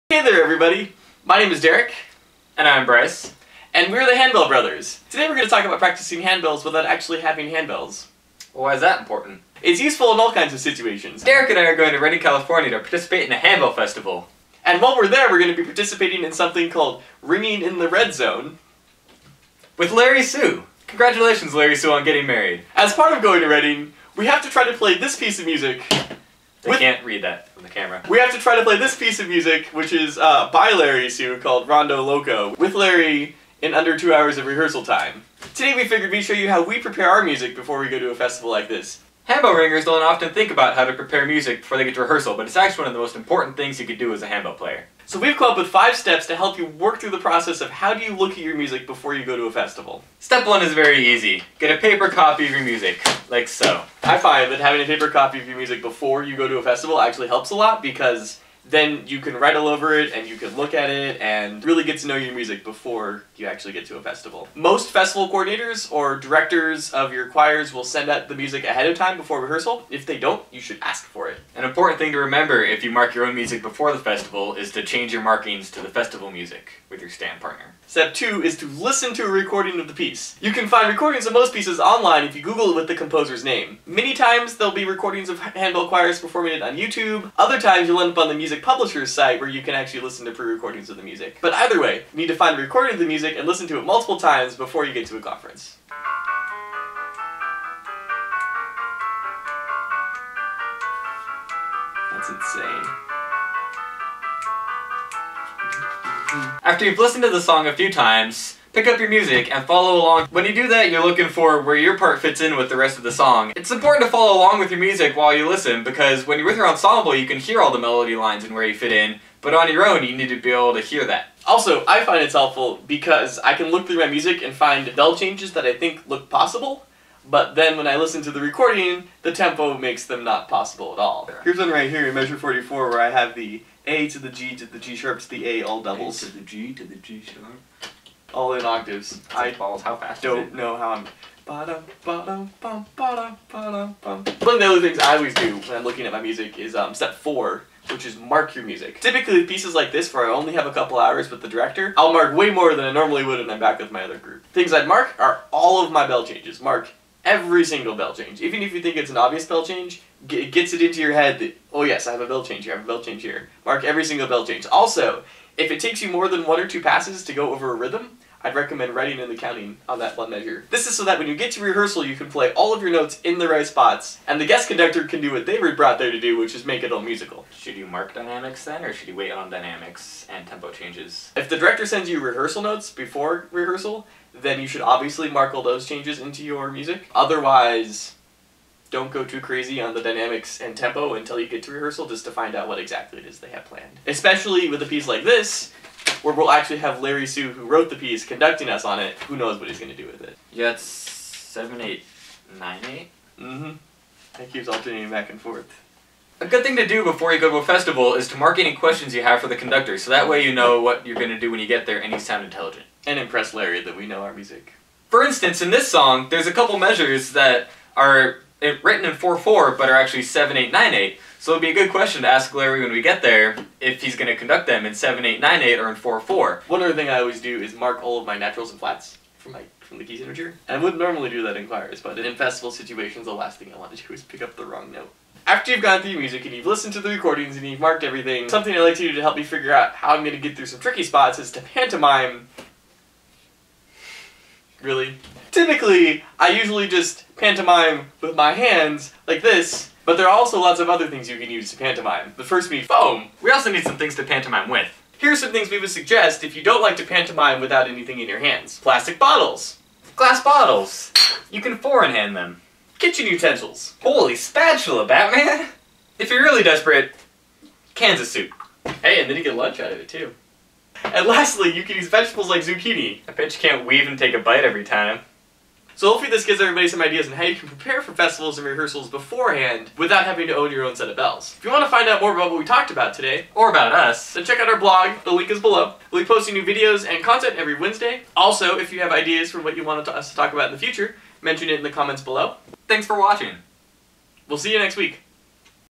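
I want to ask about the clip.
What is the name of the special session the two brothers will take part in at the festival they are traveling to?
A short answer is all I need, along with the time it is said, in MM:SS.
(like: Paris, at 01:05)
Ringing in the Red Zone, at 00:17.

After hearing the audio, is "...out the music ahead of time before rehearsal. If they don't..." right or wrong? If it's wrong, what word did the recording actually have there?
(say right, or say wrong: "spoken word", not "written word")
right.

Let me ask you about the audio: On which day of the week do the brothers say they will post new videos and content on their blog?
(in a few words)
Wednesday.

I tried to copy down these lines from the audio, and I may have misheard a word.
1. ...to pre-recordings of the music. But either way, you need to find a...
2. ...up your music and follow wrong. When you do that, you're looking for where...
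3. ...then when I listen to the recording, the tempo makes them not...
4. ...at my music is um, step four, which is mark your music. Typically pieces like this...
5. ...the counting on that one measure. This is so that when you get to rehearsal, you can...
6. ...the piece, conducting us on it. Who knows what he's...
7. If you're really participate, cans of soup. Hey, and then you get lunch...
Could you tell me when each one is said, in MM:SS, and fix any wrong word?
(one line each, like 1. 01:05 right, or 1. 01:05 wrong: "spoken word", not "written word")
1. 01:30 right
2. 01:48 wrong: "along", not "wrong"
3. 02:07 right
4. 02:26 right
5. 02:49 right
6. 03:17 right
7. 04:26 wrong: "desperate", not "participate".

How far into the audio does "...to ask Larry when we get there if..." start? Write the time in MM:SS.
03:42.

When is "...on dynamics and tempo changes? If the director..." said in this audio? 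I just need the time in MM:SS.
02:59.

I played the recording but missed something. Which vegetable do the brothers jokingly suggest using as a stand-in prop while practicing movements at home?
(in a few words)
zucchini.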